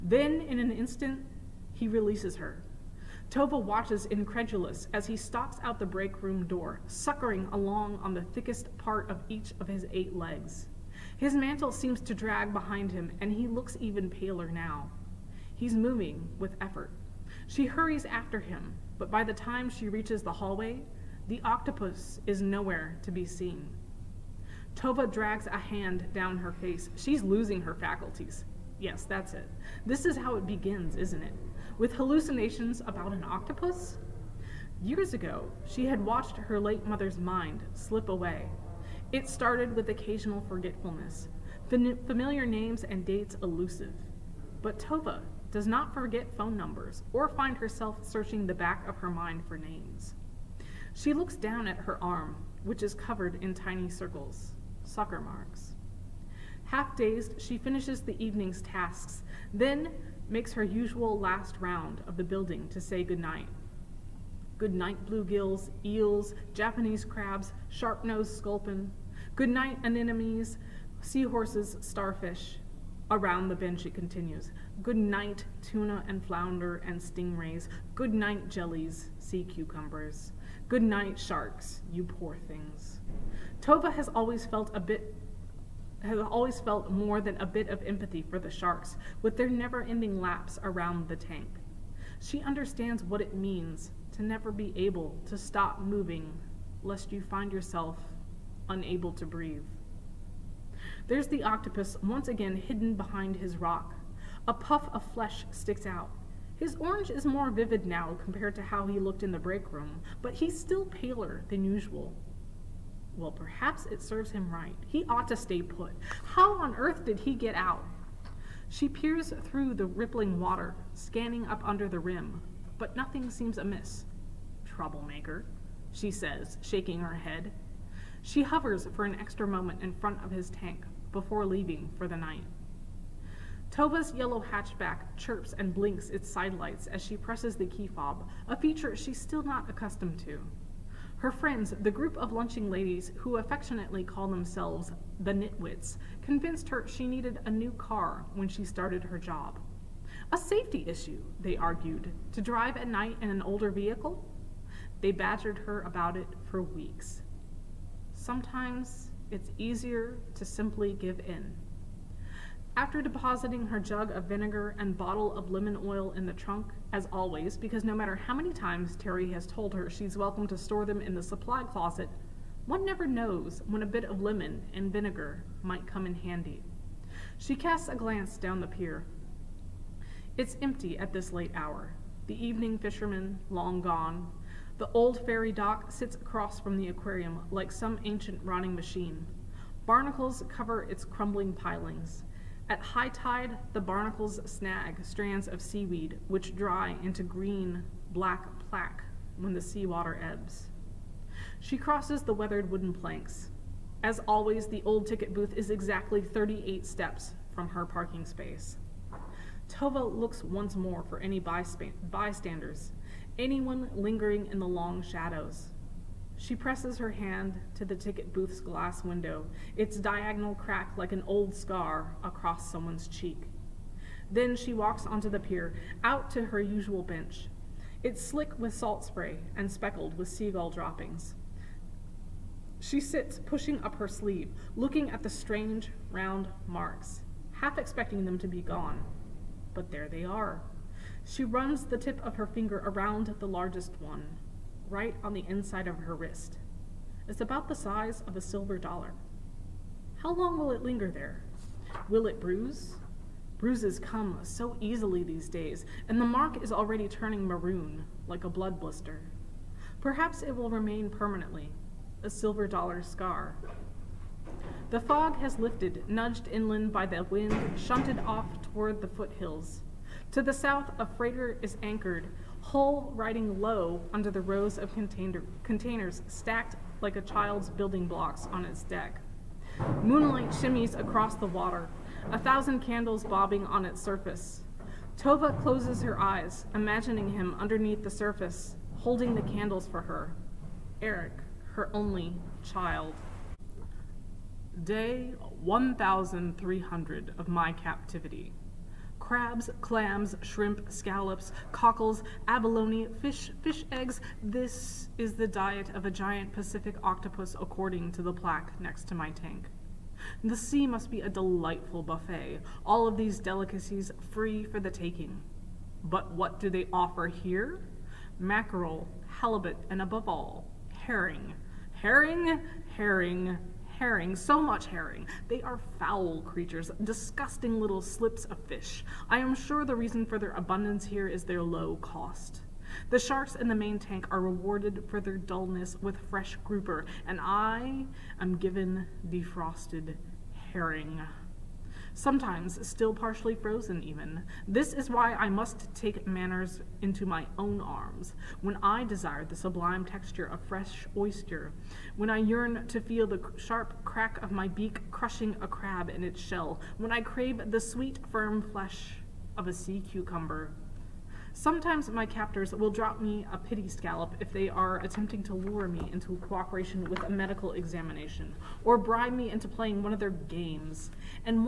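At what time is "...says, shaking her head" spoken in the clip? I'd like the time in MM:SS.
02:06.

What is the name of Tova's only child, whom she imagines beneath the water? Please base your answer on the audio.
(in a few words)
Eric.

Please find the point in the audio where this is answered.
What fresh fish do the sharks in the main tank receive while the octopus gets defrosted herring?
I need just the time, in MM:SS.
05:36.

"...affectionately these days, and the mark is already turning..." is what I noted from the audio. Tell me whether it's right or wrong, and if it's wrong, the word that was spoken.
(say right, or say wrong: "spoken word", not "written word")
wrong: "easily", not "affectionately".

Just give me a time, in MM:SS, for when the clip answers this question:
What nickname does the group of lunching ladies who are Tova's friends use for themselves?
02:25.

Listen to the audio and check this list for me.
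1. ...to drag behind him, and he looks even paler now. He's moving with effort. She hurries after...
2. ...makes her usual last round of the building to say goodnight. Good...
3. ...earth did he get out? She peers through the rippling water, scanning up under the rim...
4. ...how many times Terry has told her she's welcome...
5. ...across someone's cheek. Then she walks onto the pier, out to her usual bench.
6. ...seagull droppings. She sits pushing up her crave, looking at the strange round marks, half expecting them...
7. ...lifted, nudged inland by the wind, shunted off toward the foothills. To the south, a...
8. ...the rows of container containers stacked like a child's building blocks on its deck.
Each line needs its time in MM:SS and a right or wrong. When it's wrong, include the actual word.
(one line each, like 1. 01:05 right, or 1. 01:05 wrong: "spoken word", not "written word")
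1. 00:12 right
2. 01:00 right
3. 01:56 right
4. 02:48 right
5. 03:42 right
6. 03:50 wrong: "sleeve", not "crave"
7. 04:25 right
8. 04:34 right.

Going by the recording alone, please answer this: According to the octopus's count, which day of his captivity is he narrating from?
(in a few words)
Day 1300.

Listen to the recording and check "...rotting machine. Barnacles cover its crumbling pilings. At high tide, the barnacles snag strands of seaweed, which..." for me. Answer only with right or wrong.
right.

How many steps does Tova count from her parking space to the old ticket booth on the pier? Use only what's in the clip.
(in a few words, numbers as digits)
38.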